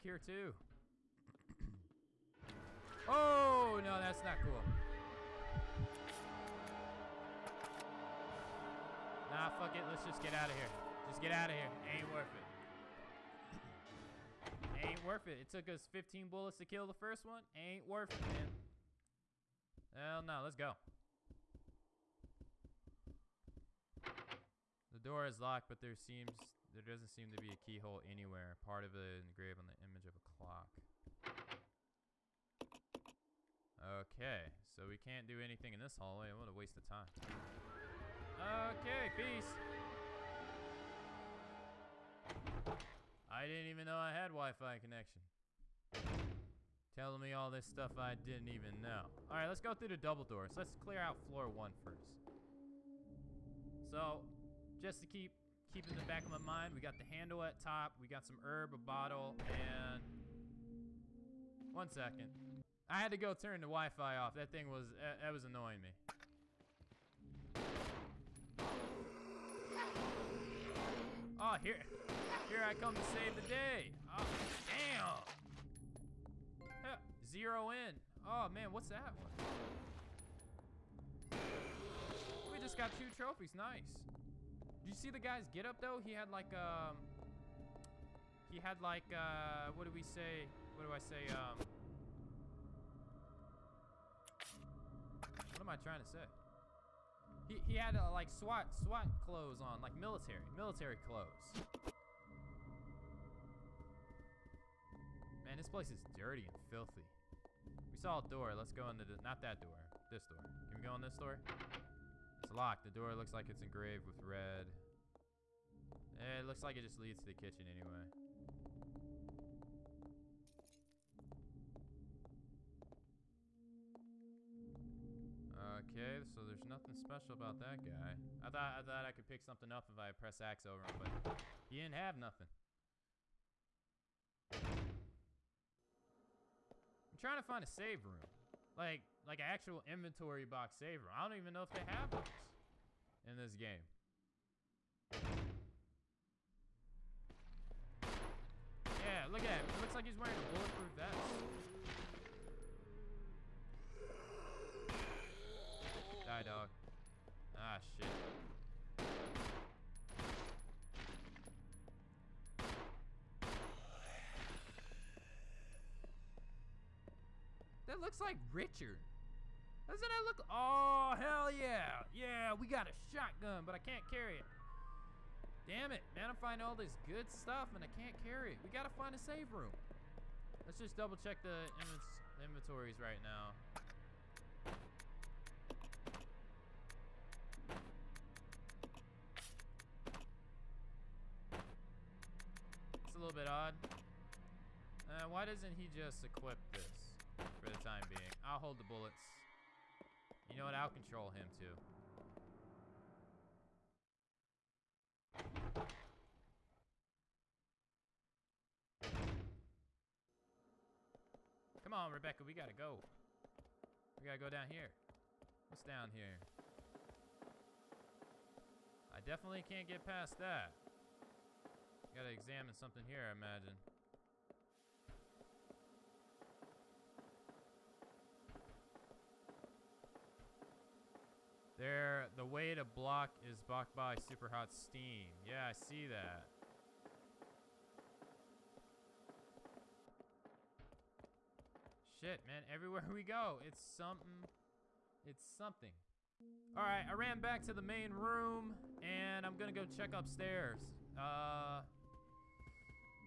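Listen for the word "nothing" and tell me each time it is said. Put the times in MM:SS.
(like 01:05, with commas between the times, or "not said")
02:06, 02:12.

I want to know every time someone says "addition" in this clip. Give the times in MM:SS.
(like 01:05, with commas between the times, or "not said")
not said.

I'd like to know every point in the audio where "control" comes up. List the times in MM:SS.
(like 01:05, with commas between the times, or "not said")
03:20.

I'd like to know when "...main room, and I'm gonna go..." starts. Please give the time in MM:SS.
04:07.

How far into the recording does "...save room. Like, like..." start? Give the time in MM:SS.
02:17.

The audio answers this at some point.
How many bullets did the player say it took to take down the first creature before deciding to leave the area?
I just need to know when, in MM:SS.
00:15.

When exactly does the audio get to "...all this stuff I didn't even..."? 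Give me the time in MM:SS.
00:47.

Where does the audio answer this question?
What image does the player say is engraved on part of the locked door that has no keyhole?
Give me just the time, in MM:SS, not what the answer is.
00:30.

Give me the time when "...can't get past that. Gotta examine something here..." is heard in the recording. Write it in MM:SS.
03:39.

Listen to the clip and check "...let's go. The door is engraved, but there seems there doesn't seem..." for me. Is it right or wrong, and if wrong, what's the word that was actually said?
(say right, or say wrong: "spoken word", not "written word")
wrong: "locked", not "engraved".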